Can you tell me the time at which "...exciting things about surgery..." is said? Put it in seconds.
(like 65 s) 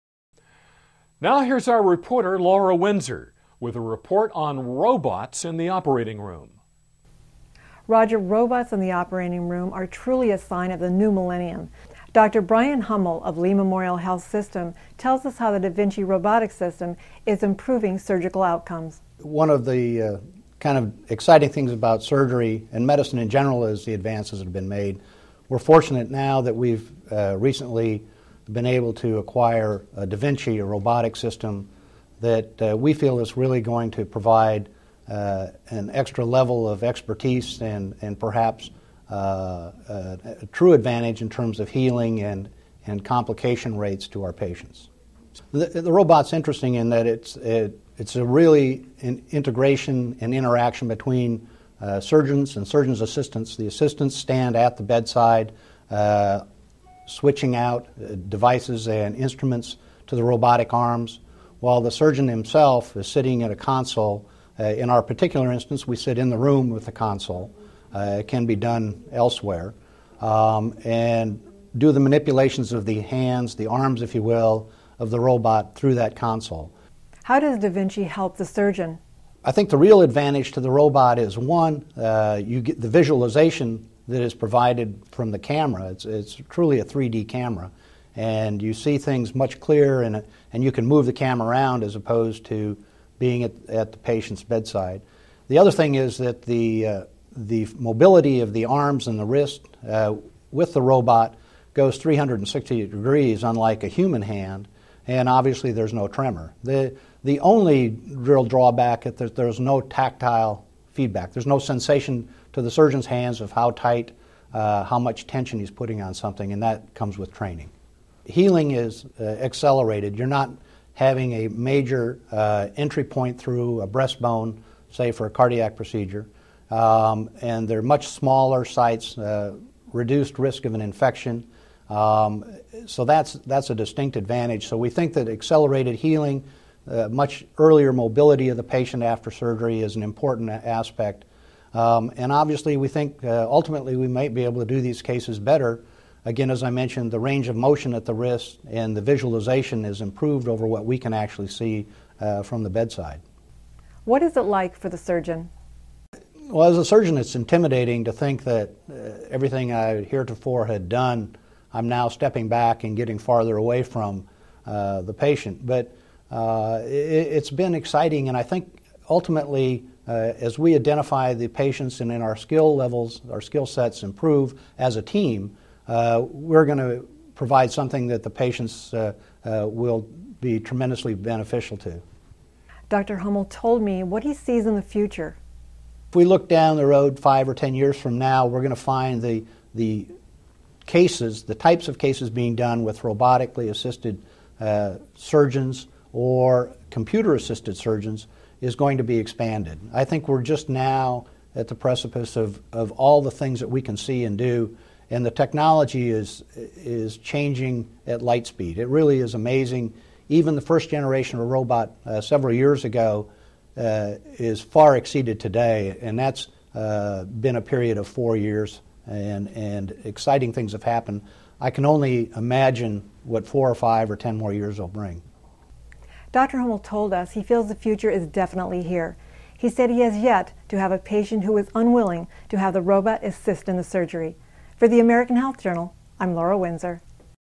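21 s.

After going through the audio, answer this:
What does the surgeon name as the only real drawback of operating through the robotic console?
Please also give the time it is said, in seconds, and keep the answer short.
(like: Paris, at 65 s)
no tactile feedback, at 109 s.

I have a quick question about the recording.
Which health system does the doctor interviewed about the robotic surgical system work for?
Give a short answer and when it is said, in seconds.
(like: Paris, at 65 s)
Lee Memorial Health System, at 13 s.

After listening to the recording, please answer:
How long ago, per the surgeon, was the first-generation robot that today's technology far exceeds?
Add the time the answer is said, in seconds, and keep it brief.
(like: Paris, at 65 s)
4 years, at 218 s.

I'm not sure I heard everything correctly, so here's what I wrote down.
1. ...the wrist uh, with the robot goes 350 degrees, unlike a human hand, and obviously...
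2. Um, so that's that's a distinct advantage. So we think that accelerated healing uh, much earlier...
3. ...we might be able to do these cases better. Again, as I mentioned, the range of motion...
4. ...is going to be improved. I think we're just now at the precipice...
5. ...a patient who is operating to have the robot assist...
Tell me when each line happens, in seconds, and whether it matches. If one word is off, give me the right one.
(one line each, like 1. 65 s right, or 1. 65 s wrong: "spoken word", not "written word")
1. 99 s wrong: "360", not "350"
2. 131 s right
3. 143 s right
4. 198 s wrong: "expanded", not "improved"
5. 230 s wrong: "unwilling", not "operating".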